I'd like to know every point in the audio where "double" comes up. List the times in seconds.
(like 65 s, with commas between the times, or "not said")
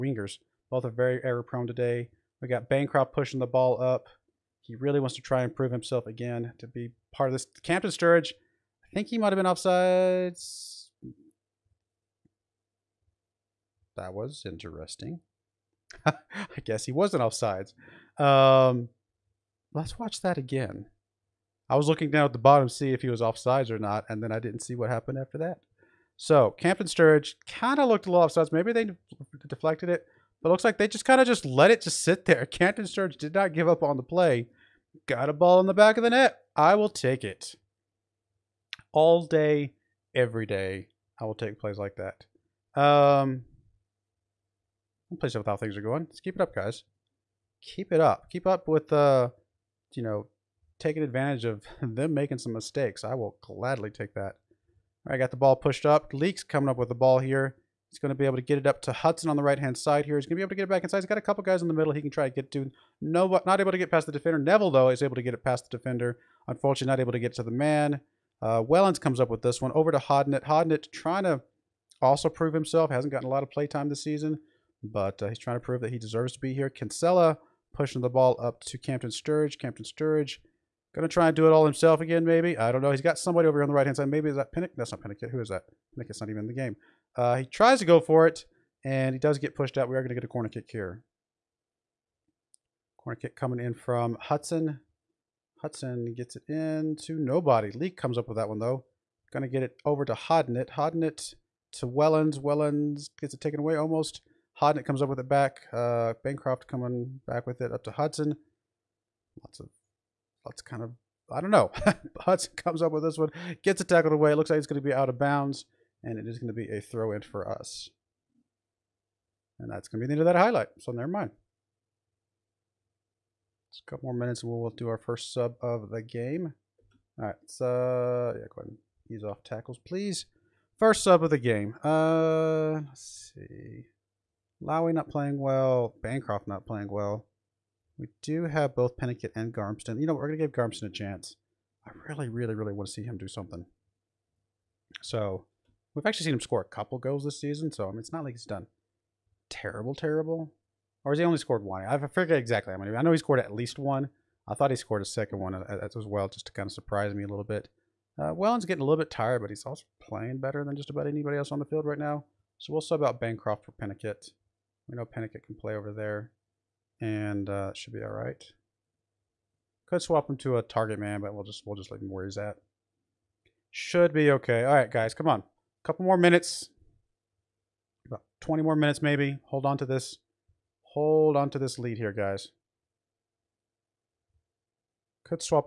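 not said.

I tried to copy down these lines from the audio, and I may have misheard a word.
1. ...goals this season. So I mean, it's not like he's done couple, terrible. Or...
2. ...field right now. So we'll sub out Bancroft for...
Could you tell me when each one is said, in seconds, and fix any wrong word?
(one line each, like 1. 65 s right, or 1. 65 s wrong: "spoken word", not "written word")
1. 146 s wrong: "terrible", not "couple"
2. 161 s right.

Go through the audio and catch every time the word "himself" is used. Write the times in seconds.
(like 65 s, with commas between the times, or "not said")
5 s, 72 s, 81 s.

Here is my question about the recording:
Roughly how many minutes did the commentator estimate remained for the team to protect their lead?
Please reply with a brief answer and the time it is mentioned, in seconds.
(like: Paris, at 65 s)
20, at 178 s.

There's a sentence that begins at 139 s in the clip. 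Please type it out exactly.
You know, we're going to give Garmston a chance.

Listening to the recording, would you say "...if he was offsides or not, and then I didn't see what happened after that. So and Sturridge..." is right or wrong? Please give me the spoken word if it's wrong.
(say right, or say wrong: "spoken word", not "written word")
right.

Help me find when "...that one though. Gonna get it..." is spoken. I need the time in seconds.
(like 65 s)
98 s.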